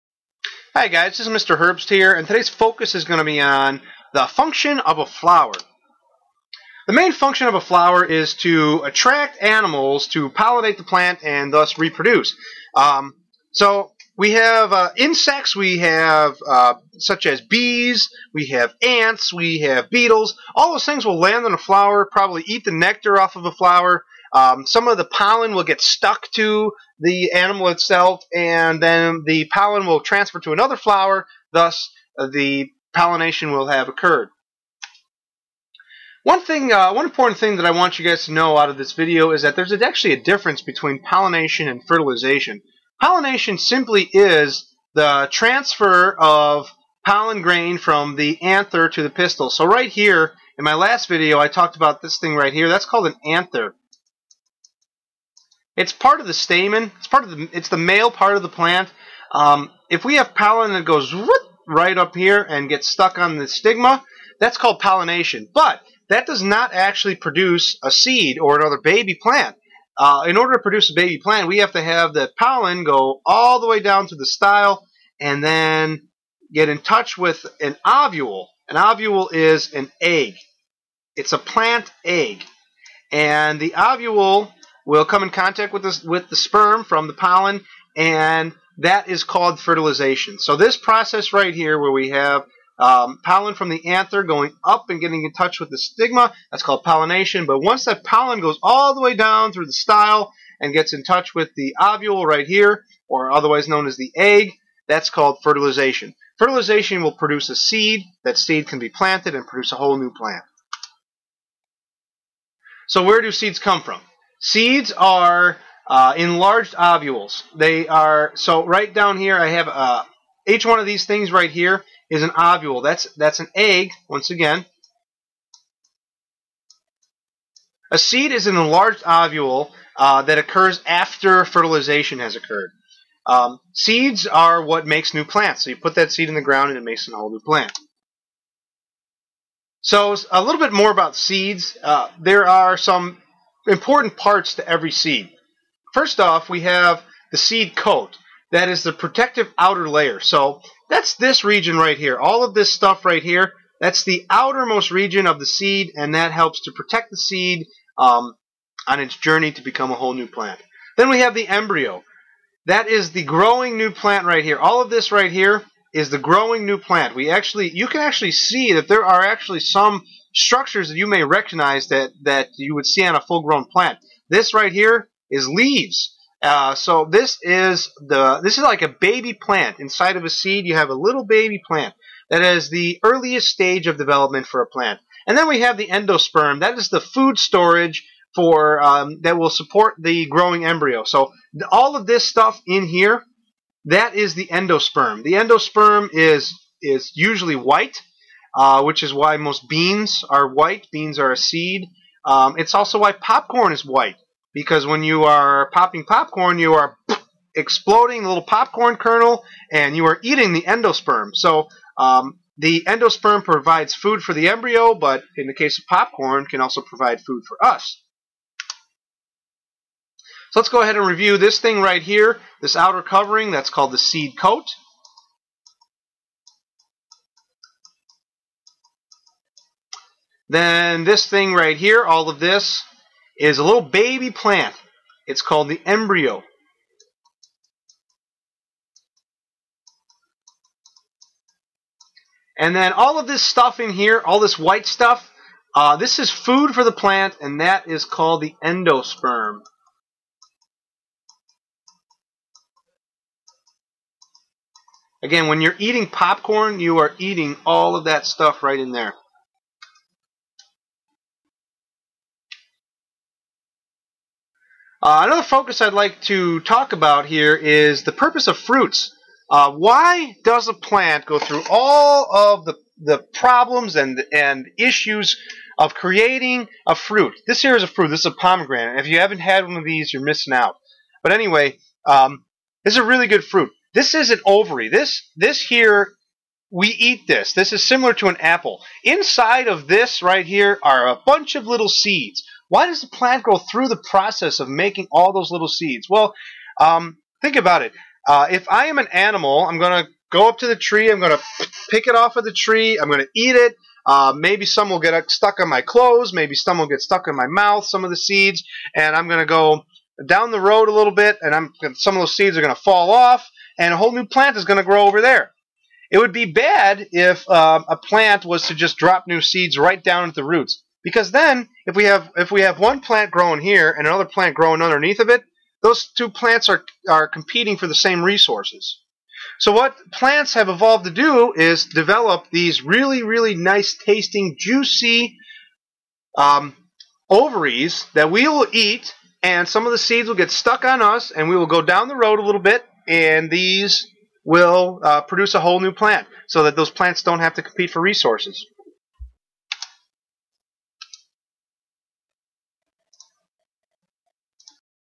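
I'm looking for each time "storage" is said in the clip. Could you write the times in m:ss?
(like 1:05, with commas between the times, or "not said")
3:07.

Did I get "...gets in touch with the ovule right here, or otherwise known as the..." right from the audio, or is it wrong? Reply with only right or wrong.
right.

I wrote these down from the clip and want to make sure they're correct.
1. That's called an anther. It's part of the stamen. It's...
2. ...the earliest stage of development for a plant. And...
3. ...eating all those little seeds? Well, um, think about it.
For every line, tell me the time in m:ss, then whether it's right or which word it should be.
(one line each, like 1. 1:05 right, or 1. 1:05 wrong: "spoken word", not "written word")
1. 0:52 right
2. 3:02 right
3. 4:54 wrong: "making", not "eating".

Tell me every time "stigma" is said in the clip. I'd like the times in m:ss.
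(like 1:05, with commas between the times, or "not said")
1:03, 1:35.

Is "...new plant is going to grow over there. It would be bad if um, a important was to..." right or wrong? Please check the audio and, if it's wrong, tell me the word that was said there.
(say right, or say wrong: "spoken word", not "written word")
wrong: "plant", not "important".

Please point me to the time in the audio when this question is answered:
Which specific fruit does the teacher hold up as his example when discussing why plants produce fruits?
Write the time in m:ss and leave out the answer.
4:38.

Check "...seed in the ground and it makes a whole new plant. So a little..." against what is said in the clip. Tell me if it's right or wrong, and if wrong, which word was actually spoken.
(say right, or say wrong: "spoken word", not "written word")
right.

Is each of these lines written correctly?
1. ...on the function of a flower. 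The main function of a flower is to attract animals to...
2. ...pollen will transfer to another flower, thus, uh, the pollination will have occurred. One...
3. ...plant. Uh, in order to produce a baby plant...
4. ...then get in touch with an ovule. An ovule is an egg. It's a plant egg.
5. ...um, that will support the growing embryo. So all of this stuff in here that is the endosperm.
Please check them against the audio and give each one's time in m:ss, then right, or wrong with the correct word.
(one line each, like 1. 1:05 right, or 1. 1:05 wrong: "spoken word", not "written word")
1. 0:03 right
2. 0:29 right
3. 1:09 right
4. 1:15 right
5. 3:08 right.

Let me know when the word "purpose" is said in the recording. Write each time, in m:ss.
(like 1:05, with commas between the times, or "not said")
4:28.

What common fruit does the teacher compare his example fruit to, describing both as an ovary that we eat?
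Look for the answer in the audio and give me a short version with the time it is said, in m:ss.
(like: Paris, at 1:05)
apple, at 4:48.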